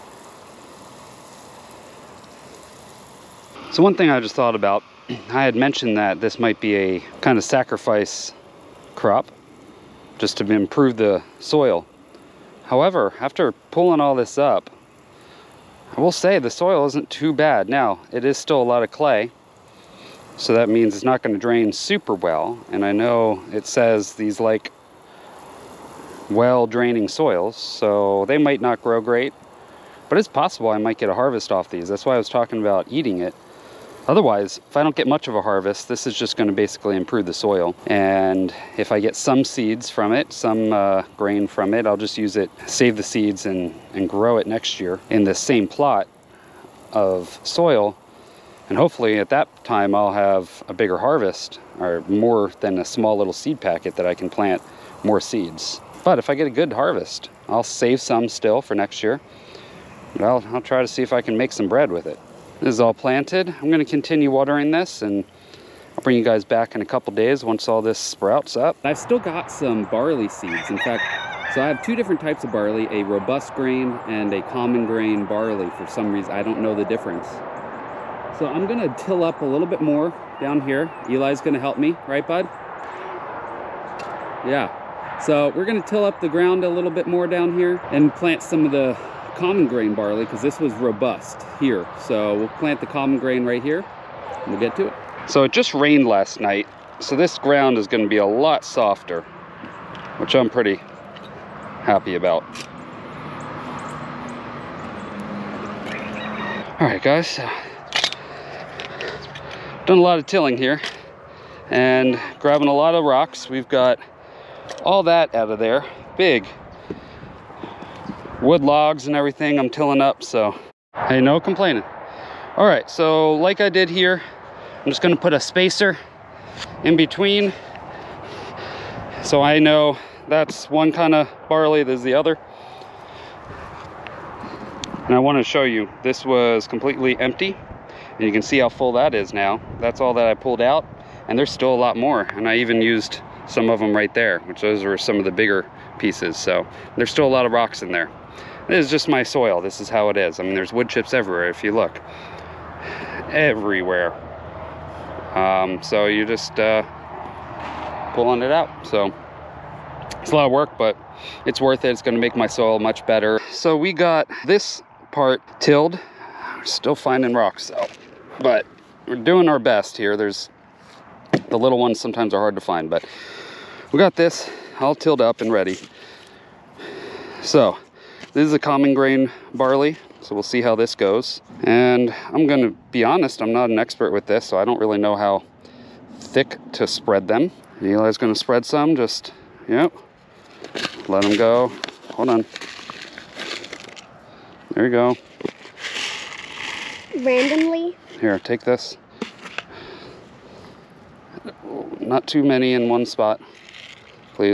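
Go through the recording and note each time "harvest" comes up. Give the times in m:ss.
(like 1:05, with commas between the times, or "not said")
0:31, 0:35, 0:50, 0:56.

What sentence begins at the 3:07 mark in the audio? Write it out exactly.
Eli's gonna spread some, just, yep.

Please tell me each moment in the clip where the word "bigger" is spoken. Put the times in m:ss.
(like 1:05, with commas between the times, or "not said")
0:50, 2:25.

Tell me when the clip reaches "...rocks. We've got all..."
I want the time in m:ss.
1:53.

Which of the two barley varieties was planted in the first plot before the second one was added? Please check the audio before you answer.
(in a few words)
Robust grain.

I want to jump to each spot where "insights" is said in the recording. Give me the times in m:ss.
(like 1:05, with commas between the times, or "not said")
not said.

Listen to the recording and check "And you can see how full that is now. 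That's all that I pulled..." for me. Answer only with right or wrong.
right.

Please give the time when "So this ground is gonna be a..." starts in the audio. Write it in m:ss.
1:37.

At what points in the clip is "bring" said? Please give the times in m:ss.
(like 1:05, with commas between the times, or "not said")
1:06.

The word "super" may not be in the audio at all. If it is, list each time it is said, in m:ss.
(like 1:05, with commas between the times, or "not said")
0:21.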